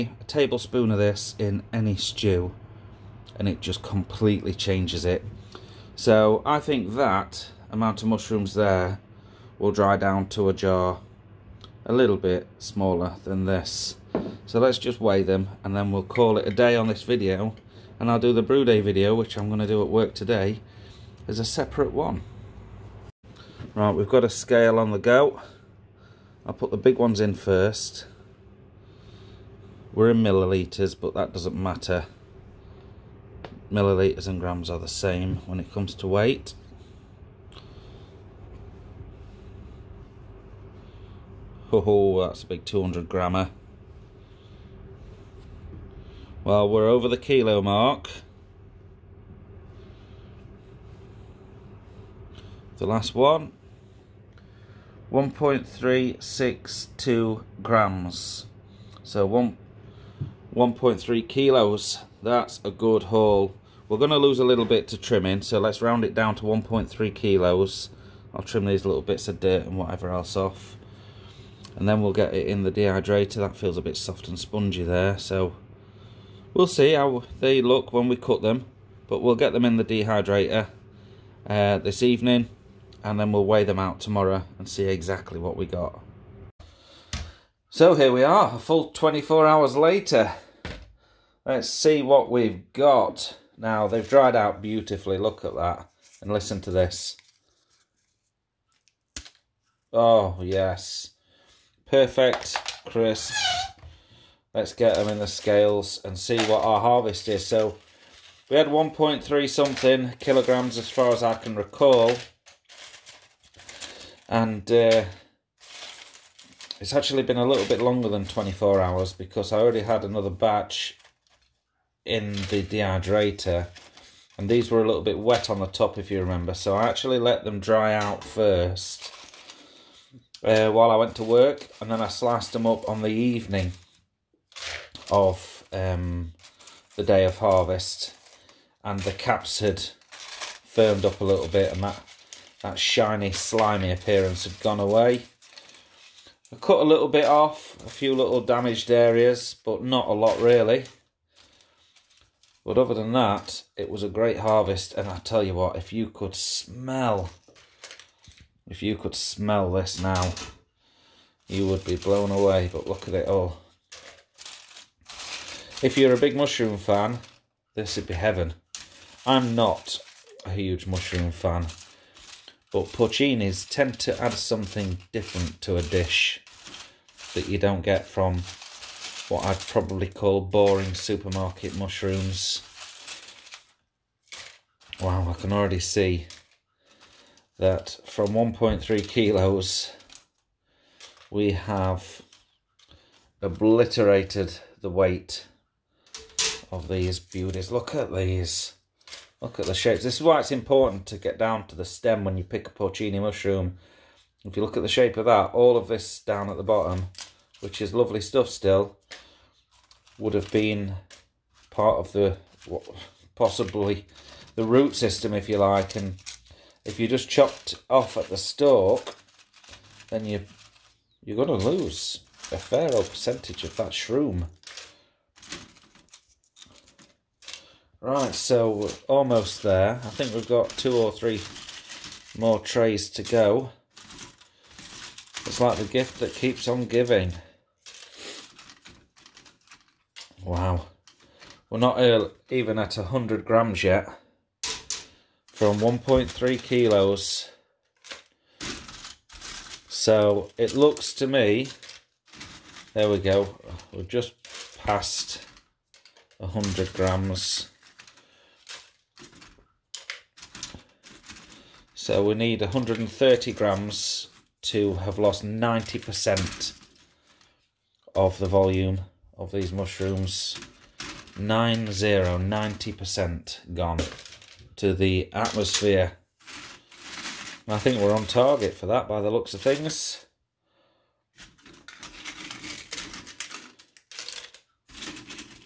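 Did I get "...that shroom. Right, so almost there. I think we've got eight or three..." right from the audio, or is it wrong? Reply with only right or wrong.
wrong.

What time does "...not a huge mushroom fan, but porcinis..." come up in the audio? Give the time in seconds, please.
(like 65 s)
169 s.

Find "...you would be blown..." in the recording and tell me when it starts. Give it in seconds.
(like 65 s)
161 s.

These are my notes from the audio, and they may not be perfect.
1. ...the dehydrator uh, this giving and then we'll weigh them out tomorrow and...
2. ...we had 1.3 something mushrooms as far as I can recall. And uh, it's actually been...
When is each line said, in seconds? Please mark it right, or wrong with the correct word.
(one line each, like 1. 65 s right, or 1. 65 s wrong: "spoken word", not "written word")
1. 79 s wrong: "evening", not "giving"
2. 108 s wrong: "kilograms", not "mushrooms".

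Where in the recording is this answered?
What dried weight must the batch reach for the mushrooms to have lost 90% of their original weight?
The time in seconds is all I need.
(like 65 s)
262 s.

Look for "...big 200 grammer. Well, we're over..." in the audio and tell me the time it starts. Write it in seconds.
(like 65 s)
42 s.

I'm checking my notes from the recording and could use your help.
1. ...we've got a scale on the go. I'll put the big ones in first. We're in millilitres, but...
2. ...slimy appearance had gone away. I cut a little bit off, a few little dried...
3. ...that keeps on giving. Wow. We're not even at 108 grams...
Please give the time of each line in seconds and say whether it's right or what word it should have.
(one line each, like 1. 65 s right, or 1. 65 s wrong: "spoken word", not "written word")
1. 23 s right
2. 143 s wrong: "damaged", not "dried"
3. 236 s wrong: "100", not "108".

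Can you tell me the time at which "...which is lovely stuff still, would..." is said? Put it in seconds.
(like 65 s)
207 s.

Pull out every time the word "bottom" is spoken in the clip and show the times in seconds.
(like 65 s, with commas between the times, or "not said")
206 s.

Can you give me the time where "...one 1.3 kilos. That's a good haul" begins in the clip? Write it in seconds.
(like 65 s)
59 s.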